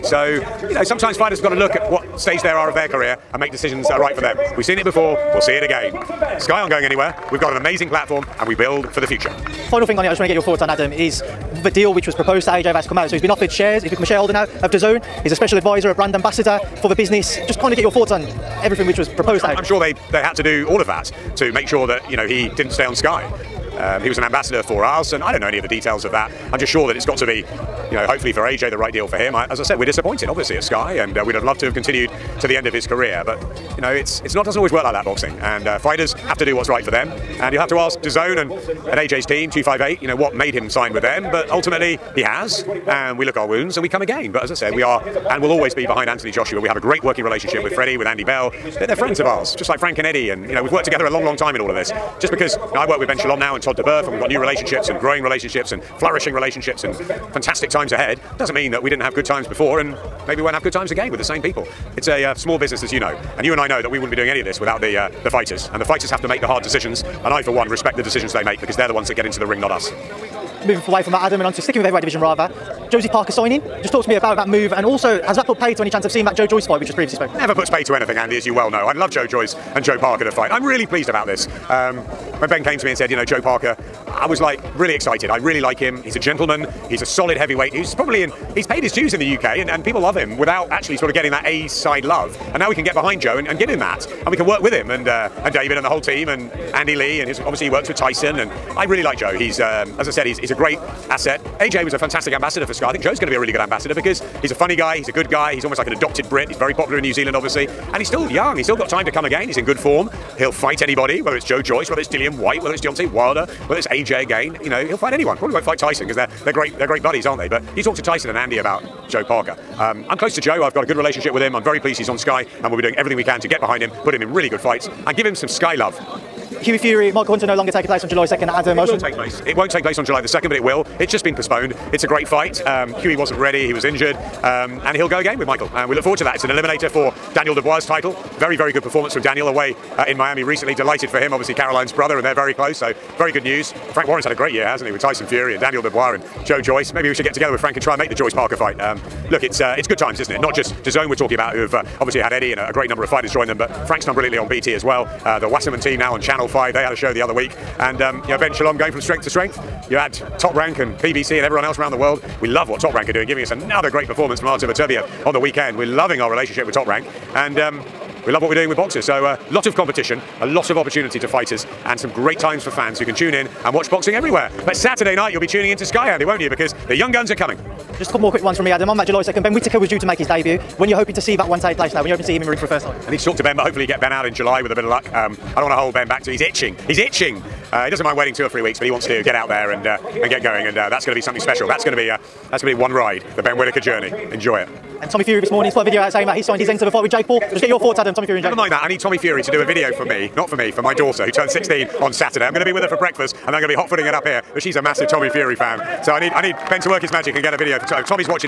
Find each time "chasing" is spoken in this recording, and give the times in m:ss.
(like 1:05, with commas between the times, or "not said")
not said.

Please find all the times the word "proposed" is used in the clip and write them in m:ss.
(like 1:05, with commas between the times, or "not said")
0:12, 0:19.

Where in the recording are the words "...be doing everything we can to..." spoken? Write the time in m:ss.
2:02.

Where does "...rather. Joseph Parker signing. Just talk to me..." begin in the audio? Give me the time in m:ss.
1:12.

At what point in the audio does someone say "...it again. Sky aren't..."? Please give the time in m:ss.
0:05.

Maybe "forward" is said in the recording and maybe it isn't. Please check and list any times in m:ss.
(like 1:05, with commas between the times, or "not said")
2:16.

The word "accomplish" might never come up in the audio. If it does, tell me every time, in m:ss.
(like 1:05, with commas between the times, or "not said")
not said.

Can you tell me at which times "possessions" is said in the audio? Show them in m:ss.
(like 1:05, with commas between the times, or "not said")
not said.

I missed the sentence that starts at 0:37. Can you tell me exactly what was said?
And you have to ask DAZN and, and AJ's team, 258, you know, what made him sign with them.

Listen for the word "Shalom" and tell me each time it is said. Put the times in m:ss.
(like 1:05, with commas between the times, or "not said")
0:53, 2:38.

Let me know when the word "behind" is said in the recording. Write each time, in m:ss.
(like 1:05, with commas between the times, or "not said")
0:45, 1:32, 2:03.